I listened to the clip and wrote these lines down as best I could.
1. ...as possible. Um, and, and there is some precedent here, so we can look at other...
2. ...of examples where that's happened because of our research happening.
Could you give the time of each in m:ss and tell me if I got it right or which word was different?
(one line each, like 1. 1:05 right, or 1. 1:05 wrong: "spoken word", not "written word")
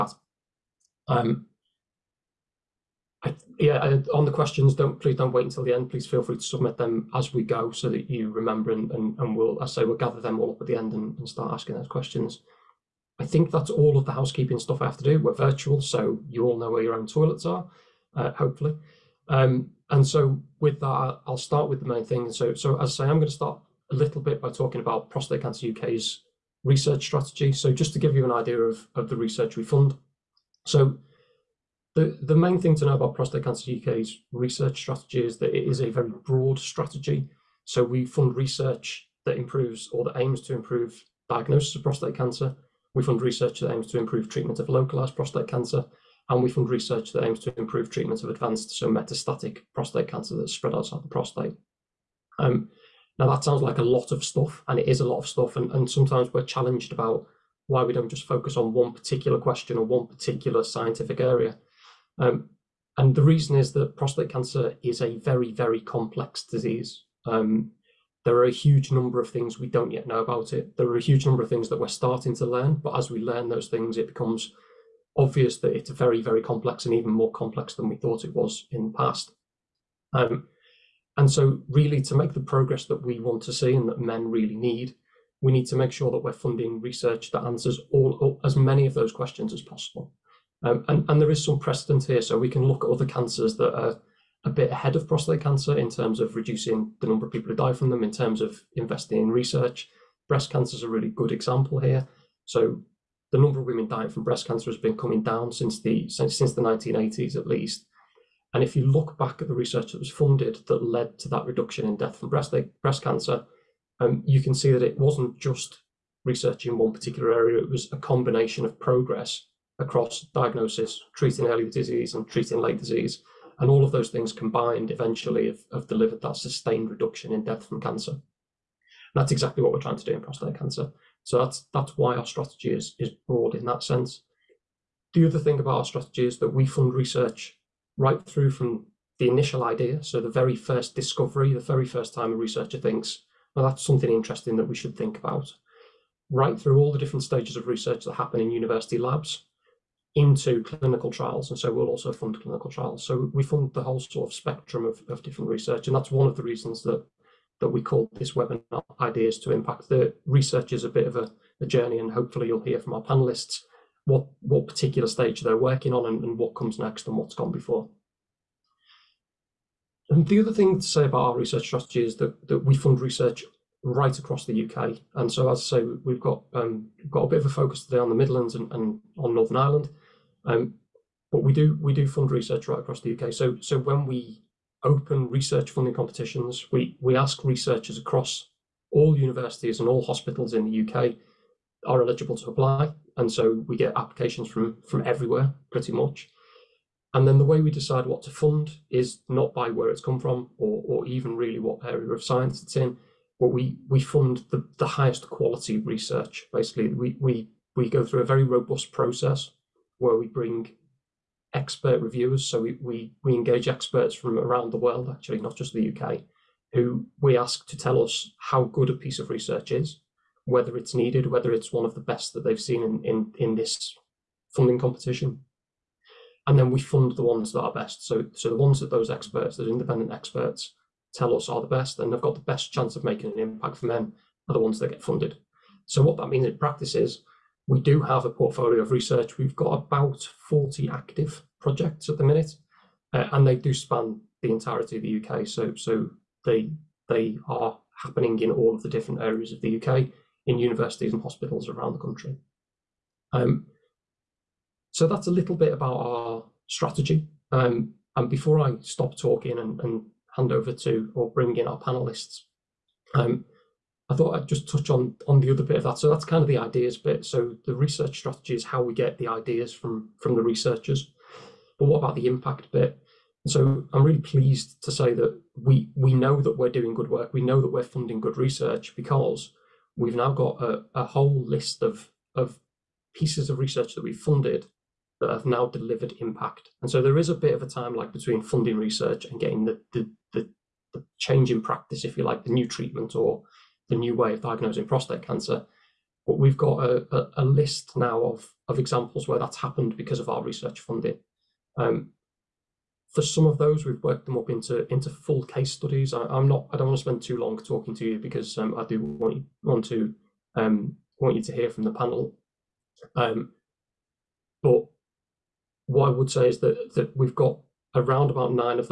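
1. 1:29 right
2. 4:58 wrong: "funding", not "happening".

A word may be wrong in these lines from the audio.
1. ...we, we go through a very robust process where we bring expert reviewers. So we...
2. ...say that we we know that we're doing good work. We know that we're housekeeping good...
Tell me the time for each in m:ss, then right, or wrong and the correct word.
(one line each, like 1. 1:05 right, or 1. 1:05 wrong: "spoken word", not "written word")
1. 3:27 right
2. 4:34 wrong: "funding", not "housekeeping".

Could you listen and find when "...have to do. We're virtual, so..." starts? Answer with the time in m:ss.
0:14.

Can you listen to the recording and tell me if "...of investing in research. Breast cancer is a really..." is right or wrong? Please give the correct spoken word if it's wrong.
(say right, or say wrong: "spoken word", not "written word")
right.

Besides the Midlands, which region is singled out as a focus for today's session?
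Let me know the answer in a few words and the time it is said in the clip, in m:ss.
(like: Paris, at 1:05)
Northern Ireland, at 2:59.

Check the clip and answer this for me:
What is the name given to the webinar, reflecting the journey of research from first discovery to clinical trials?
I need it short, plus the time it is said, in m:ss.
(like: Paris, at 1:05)
Ideas to Impact, at 2:39.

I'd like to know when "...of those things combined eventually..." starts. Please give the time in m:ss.
2:03.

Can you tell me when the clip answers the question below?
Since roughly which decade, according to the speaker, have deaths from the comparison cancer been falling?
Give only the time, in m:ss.
1:46.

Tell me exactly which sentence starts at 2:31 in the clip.
And so we'll also fund clinical trials.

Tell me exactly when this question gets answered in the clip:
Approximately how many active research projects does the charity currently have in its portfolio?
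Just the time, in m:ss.
3:59.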